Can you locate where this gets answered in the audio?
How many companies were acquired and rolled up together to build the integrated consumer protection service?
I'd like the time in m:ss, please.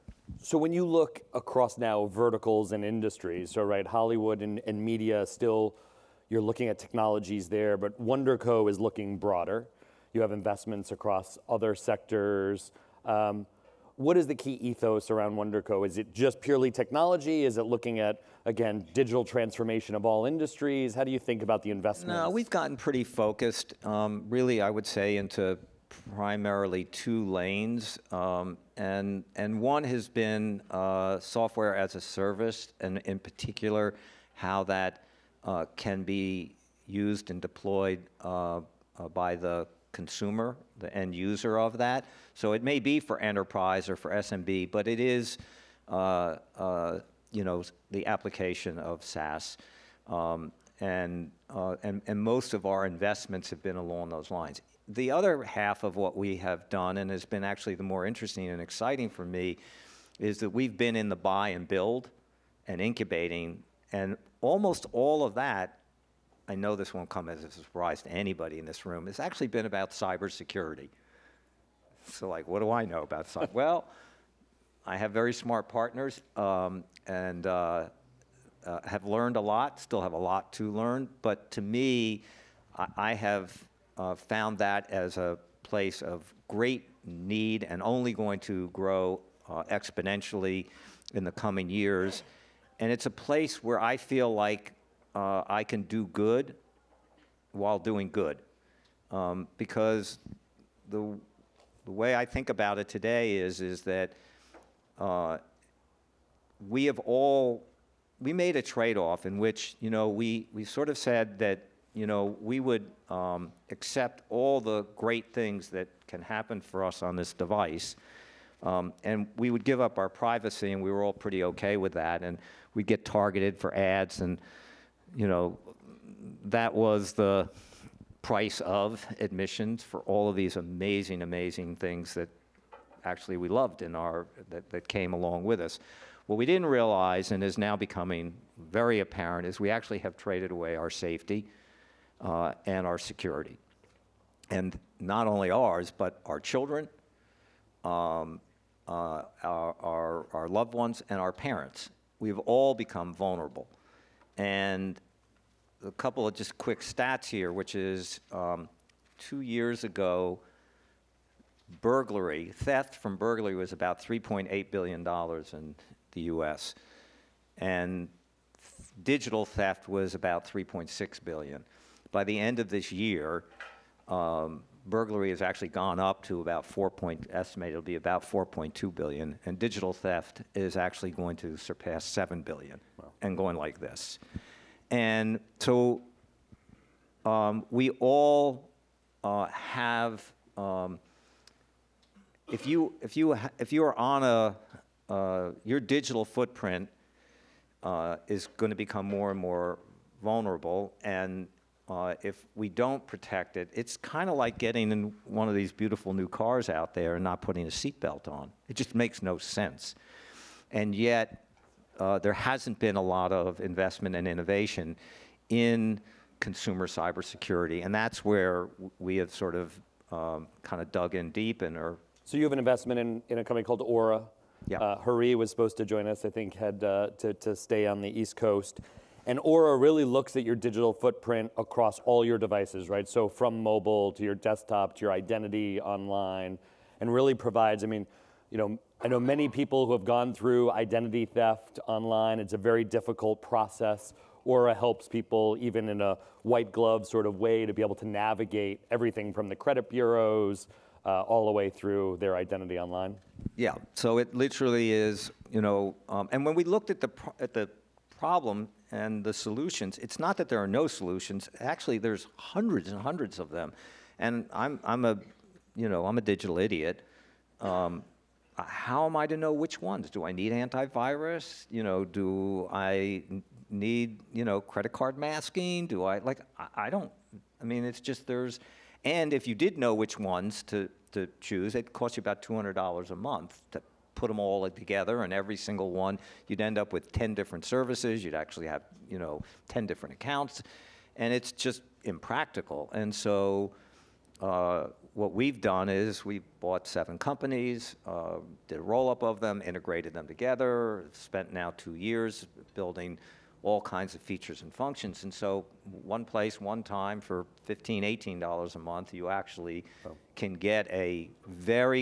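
4:56.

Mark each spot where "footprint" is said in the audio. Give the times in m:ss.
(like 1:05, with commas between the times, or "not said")
3:16, 3:50.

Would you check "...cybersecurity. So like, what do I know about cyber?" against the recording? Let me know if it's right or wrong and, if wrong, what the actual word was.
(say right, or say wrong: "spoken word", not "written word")
right.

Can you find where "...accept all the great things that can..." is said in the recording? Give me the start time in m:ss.
1:53.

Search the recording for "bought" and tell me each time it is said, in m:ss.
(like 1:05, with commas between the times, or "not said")
4:56.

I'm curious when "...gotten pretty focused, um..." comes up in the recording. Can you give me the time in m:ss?
0:22.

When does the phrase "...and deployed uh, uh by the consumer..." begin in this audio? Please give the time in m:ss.
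0:37.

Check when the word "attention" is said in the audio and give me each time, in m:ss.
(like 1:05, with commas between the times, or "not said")
not said.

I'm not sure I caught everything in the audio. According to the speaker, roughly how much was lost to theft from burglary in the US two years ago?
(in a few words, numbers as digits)
$3.8 billion.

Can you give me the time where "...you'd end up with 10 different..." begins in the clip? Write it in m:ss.
4:46.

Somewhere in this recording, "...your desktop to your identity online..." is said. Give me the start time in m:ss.
3:54.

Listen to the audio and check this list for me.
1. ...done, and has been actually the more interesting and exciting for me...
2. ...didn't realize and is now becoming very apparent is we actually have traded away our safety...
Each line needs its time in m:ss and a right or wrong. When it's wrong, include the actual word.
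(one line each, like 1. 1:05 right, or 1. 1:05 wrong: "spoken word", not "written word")
1. 0:56 right
2. 2:16 right.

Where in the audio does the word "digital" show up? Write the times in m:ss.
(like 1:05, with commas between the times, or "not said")
0:18, 2:49, 2:59, 3:15, 3:50, 4:26.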